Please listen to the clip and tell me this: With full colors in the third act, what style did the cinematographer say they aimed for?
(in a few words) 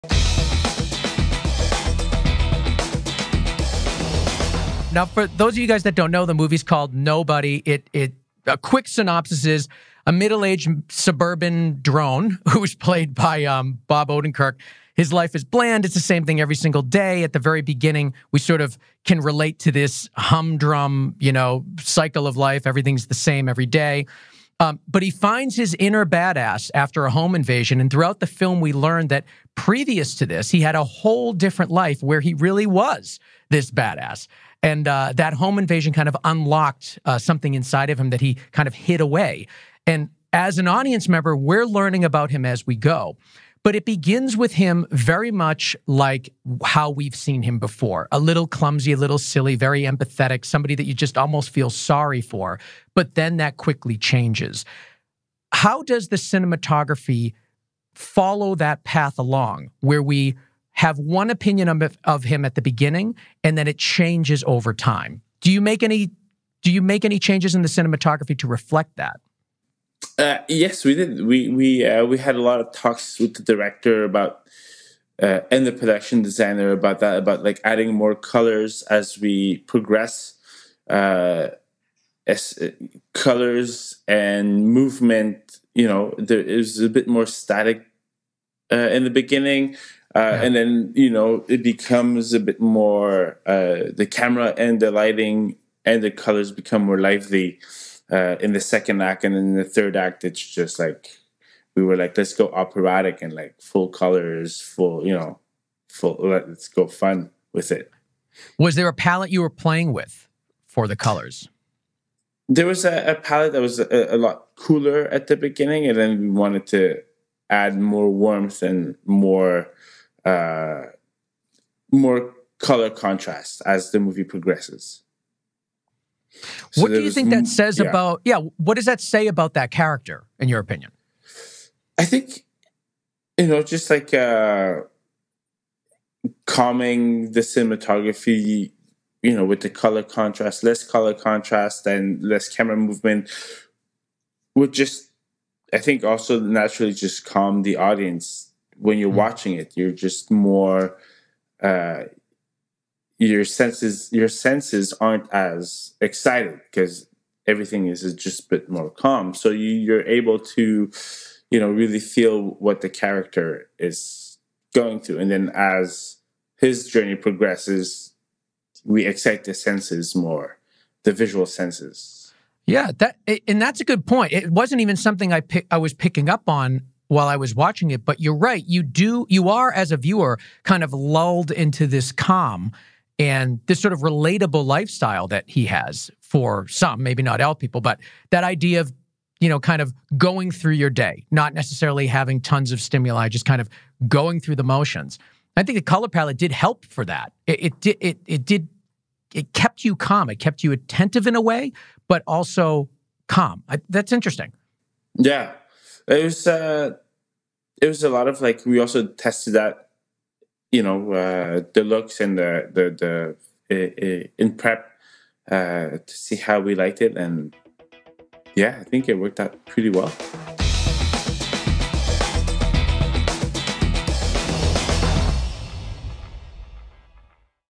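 operatic.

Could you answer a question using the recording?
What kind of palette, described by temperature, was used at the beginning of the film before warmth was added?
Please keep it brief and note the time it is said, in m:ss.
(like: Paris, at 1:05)
cooler, at 1:54.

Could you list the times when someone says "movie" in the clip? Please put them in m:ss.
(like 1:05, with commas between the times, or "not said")
0:06, 2:04.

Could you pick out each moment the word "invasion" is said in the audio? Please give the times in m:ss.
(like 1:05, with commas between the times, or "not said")
0:27, 0:35.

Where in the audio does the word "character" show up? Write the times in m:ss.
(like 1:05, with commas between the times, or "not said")
2:09, 2:42.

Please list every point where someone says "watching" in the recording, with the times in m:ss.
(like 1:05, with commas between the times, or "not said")
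2:29, 2:57.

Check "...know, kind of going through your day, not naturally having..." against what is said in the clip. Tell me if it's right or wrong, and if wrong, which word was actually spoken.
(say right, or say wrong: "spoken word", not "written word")
wrong: "necessarily", not "naturally".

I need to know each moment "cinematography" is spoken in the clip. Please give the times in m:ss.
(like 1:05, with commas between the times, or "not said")
0:56, 1:07, 2:17.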